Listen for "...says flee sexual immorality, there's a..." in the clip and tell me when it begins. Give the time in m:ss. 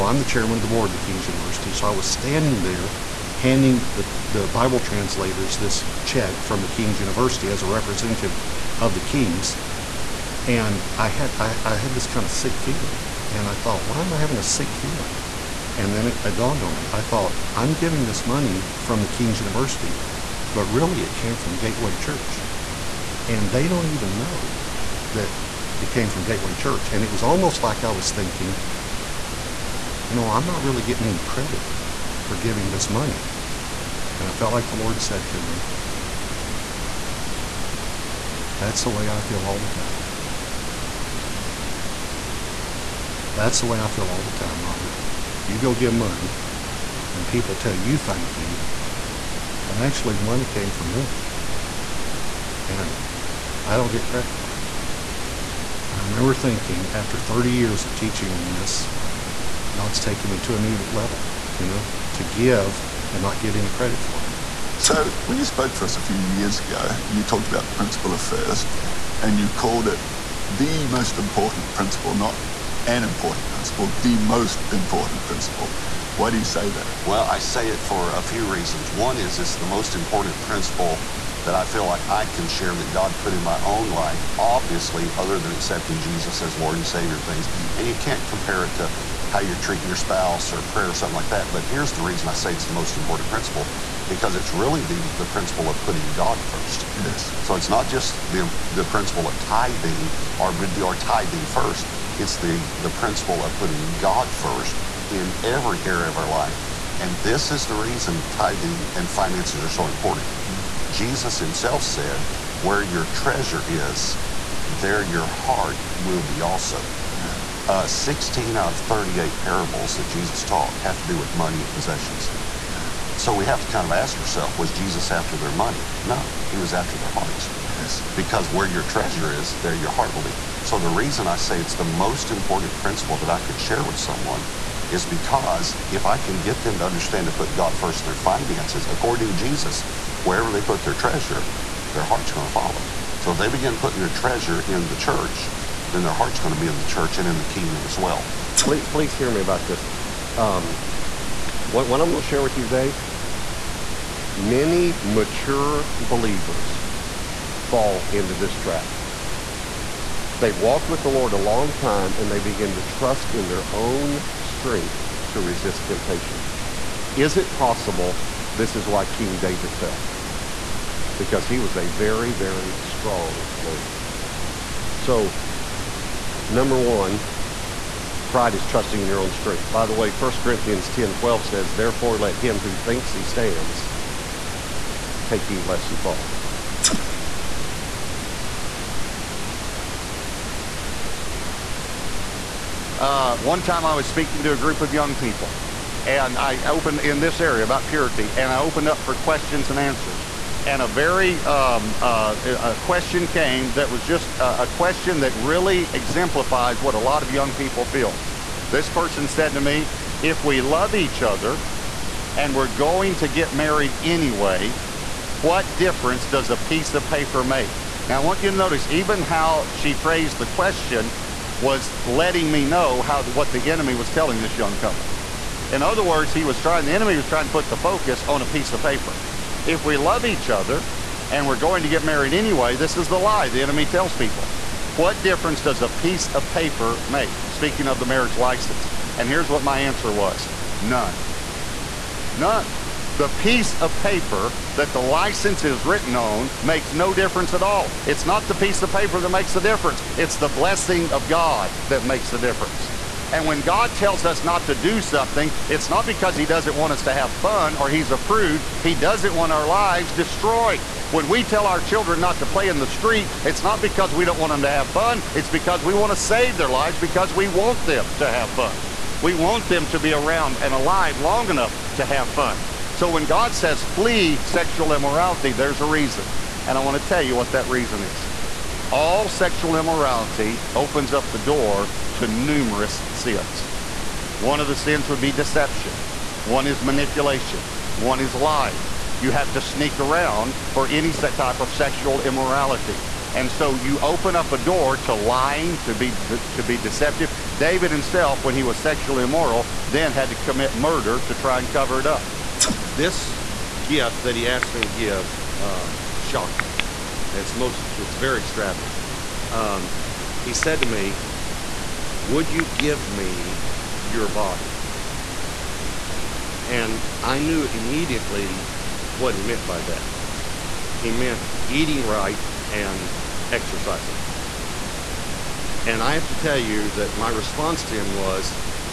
4:33.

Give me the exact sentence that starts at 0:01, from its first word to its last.
So I was standing there handing the, the Bible translators this check from the King's University as a representative of the King's.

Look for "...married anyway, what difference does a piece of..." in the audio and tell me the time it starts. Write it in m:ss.
3:33.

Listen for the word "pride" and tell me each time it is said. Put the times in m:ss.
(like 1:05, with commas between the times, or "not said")
2:58.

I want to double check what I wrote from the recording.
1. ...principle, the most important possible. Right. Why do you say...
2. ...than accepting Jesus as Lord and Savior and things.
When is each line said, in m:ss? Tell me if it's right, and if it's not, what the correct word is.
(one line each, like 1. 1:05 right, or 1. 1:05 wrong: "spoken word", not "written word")
1. 1:13 wrong: "principle", not "possible"
2. 1:25 right.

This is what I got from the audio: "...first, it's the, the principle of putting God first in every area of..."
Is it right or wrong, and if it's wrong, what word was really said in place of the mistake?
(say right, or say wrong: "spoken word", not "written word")
right.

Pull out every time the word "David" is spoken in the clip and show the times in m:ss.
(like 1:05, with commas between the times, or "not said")
2:49, 4:57.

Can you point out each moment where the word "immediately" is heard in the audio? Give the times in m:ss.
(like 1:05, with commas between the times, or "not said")
5:17.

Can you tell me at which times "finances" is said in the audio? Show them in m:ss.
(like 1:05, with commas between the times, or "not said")
1:49, 2:18.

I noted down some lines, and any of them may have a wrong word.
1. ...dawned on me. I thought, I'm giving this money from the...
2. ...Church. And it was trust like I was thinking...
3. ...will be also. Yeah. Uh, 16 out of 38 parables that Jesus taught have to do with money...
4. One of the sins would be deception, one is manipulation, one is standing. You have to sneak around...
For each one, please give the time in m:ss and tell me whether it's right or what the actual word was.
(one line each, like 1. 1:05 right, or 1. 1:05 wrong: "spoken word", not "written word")
1. 0:16 right
2. 0:26 wrong: "almost", not "trust"
3. 1:55 right
4. 4:44 wrong: "lying", not "standing".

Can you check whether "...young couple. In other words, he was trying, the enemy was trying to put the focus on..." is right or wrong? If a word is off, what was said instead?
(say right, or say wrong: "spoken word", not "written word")
right.